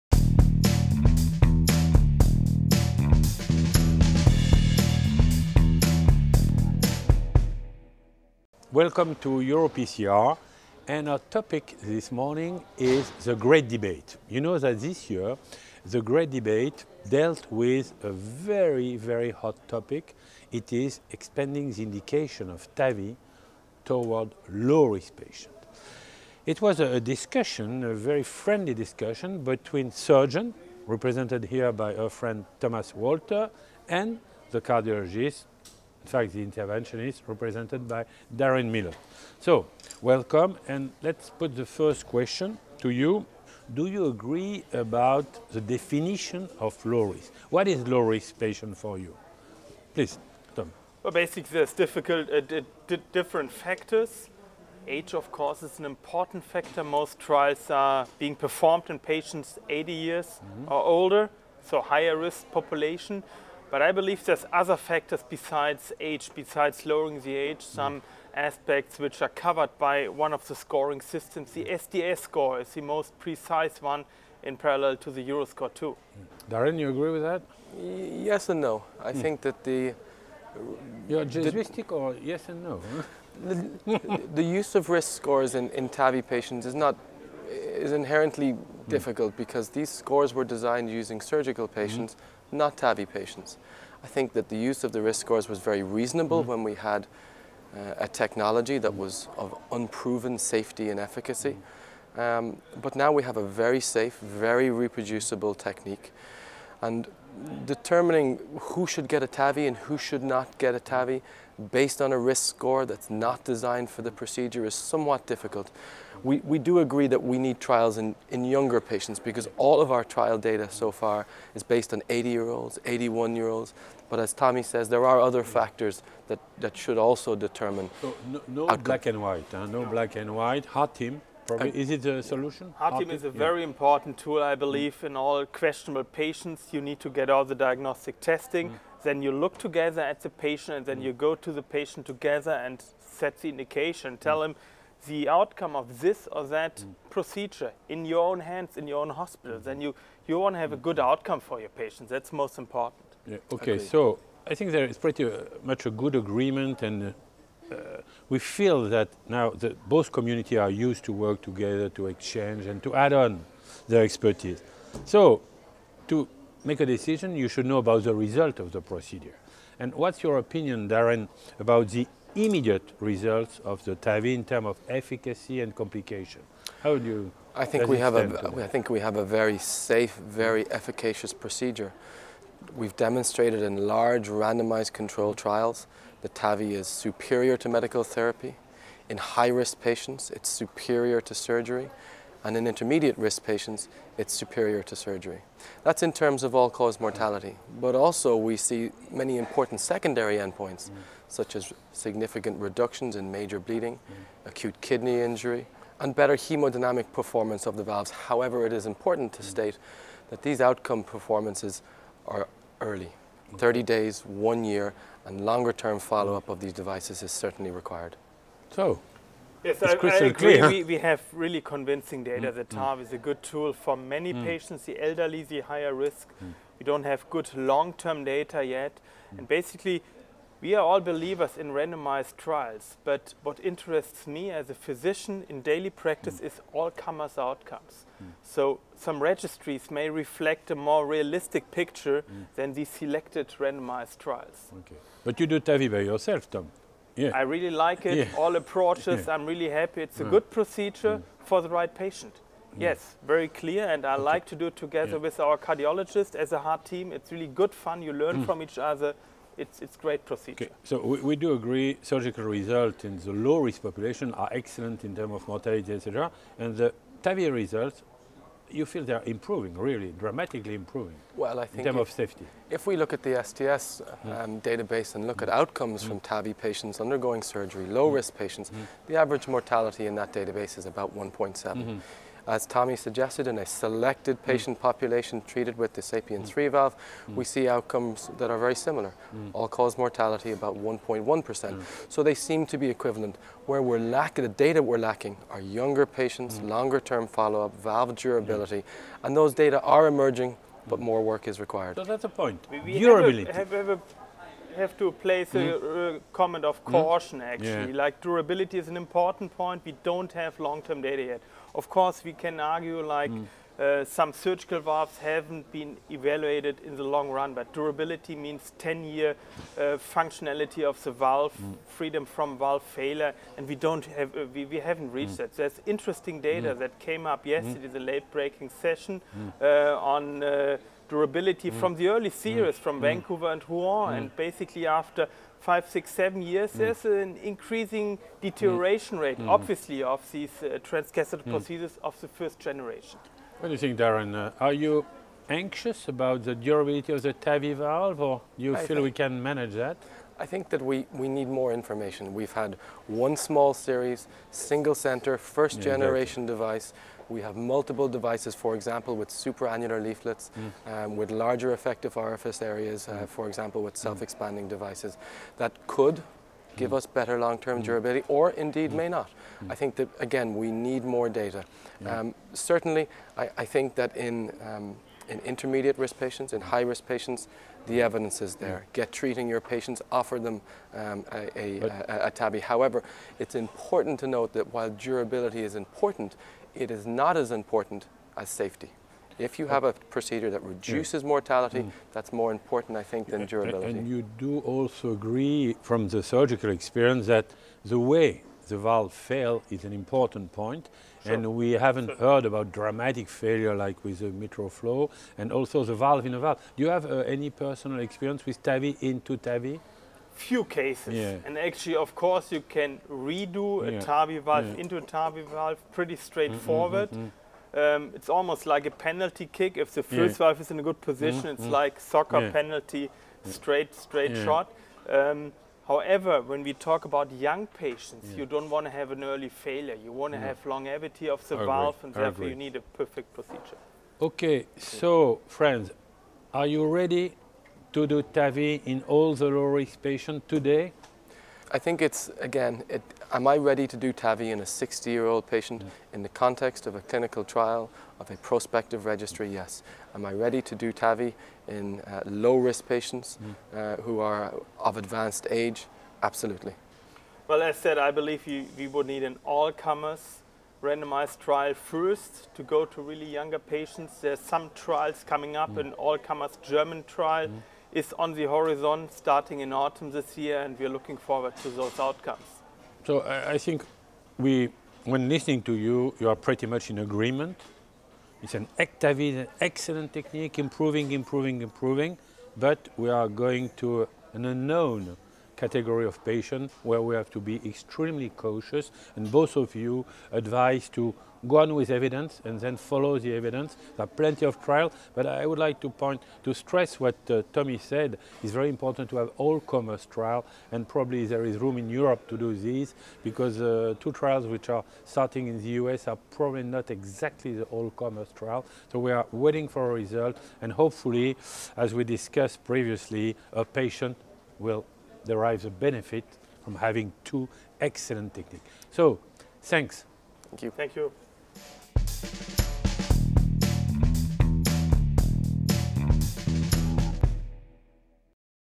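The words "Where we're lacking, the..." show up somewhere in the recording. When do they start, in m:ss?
4:53.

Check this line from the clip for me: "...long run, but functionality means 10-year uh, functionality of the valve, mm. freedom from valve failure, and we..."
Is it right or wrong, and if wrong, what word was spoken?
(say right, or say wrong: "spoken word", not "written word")
wrong: "durability", not "functionality".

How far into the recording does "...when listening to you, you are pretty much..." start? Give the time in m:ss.
7:55.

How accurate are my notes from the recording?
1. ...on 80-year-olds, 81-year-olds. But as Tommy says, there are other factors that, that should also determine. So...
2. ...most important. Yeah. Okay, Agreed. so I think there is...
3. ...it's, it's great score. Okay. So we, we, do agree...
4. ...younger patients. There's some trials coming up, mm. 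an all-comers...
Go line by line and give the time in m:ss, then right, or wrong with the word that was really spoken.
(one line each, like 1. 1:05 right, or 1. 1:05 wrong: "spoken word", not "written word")
1. 2:01 right
2. 2:32 right
3. 4:19 wrong: "procedure", not "score"
4. 7:43 right.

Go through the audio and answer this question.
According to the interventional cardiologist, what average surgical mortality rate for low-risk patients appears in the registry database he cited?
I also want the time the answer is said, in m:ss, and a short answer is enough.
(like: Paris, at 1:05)
1.7%, at 4:41.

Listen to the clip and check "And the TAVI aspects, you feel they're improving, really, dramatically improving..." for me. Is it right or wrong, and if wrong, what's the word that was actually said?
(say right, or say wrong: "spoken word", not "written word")
wrong: "results", not "aspects".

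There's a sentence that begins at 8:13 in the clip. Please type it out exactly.
There are plenty of trials, but I would like to point to stress what uh, Tommy said.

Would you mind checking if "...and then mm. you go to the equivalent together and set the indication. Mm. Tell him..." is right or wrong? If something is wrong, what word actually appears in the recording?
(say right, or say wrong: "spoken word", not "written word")
wrong: "patient", not "equivalent".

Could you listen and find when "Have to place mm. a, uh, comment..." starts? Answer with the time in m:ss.
5:04.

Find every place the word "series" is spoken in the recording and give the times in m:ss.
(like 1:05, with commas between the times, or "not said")
5:32, 5:53.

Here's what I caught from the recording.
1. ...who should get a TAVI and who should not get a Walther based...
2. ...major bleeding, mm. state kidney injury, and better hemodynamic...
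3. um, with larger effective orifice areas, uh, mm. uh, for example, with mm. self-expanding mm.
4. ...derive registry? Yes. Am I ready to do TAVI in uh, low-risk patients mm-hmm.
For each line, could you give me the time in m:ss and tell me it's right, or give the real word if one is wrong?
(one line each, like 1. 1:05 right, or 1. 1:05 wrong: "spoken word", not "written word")
1. 1:48 wrong: "TAVI", not "Walther"
2. 3:23 wrong: "acute", not "state"
3. 6:01 right
4. 7:28 wrong: "prospective", not "derive".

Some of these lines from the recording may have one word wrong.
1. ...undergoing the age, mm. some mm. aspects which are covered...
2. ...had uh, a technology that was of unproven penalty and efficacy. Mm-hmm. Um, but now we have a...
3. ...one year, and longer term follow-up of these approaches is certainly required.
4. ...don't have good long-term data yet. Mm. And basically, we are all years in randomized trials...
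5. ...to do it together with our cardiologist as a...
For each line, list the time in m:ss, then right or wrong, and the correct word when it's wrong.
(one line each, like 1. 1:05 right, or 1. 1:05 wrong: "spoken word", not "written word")
1. 1:06 wrong: "lowering", not "undergoing"
2. 1:36 wrong: "safety", not "penalty"
3. 3:34 wrong: "devices", not "approaches"
4. 3:46 wrong: "believers", not "years"
5. 4:14 right.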